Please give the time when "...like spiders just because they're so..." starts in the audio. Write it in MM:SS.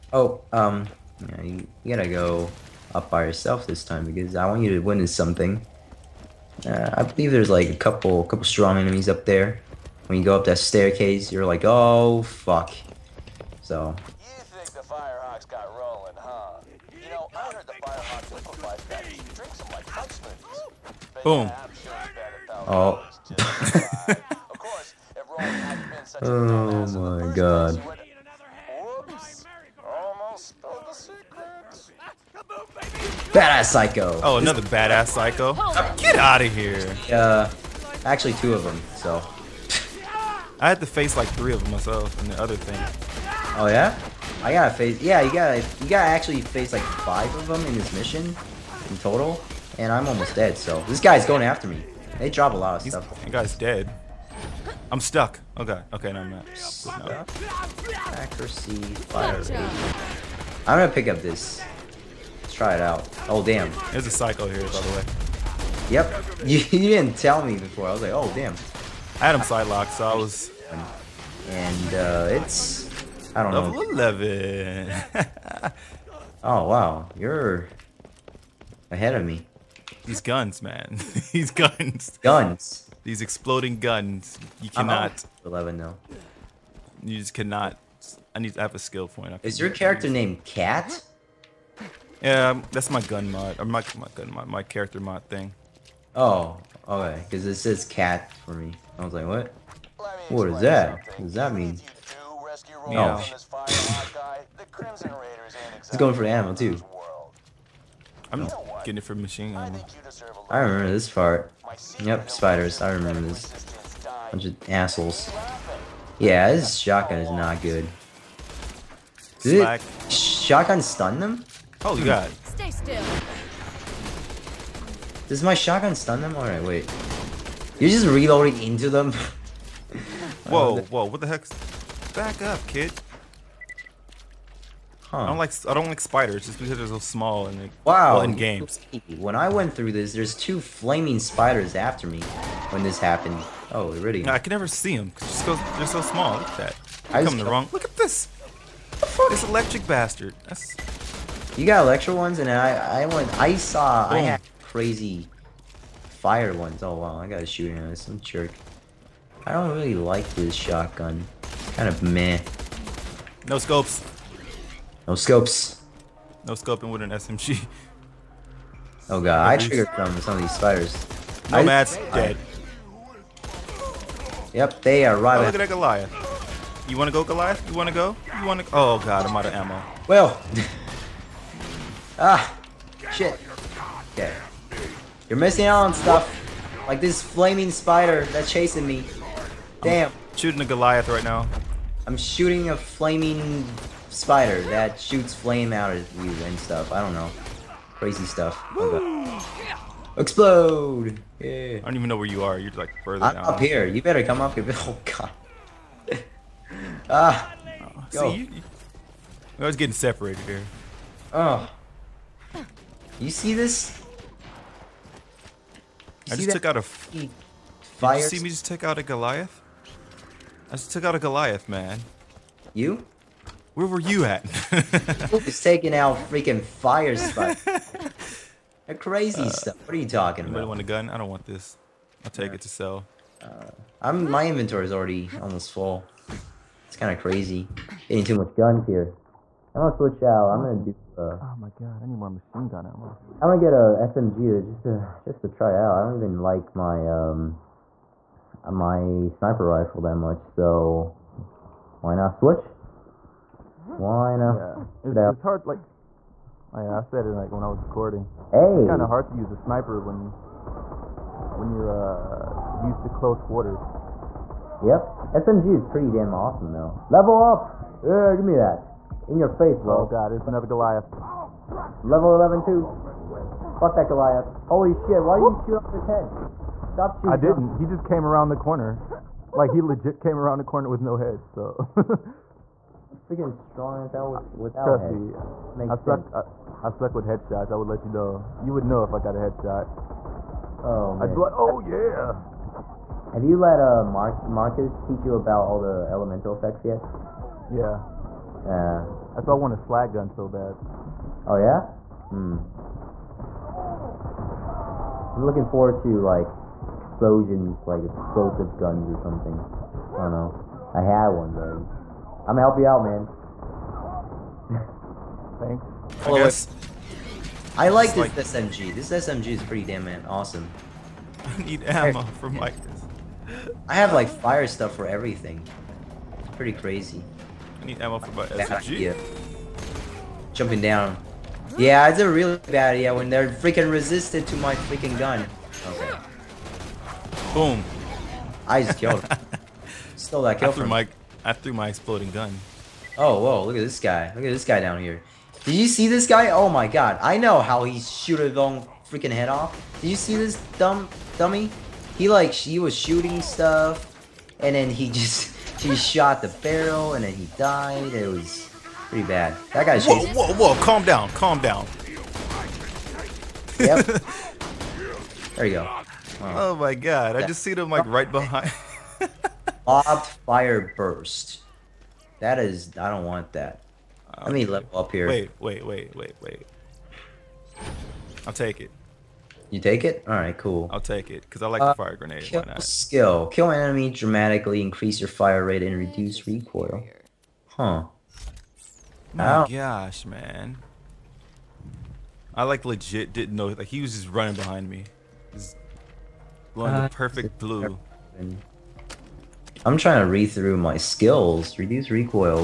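02:15.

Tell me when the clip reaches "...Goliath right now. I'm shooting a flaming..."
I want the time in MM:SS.
03:10.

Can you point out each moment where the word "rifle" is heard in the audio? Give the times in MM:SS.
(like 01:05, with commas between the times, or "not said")
04:09.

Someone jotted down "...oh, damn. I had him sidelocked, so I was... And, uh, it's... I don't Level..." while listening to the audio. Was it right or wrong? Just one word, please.
right.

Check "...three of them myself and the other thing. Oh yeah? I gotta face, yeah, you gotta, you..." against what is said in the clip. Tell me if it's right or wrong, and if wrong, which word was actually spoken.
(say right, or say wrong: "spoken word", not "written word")
right.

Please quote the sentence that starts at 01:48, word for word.
I'm getting it for machine gun.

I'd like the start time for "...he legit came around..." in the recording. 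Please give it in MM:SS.
04:39.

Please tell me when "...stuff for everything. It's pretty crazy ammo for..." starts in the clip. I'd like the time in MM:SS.
05:24.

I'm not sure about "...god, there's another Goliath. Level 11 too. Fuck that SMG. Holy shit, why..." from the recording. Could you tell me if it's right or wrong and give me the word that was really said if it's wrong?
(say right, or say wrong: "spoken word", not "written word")
wrong: "Goliath", not "SMG".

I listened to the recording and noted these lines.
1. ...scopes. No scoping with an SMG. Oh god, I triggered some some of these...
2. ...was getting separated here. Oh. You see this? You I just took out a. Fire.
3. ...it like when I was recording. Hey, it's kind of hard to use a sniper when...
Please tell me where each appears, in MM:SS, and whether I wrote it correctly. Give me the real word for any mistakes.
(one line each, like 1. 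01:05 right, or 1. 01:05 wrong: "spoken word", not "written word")
1. 02:45 right
2. 03:29 right
3. 04:17 right.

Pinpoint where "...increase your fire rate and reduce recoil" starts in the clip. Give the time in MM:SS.
06:24.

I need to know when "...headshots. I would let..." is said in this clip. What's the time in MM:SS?
04:47.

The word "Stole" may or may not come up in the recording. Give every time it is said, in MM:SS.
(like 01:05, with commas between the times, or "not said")
05:40.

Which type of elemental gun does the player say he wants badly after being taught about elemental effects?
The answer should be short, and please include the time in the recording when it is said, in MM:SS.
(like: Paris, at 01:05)
Slag gun, at 04:59.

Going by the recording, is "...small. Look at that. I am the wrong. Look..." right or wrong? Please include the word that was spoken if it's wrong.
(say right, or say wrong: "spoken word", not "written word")
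right.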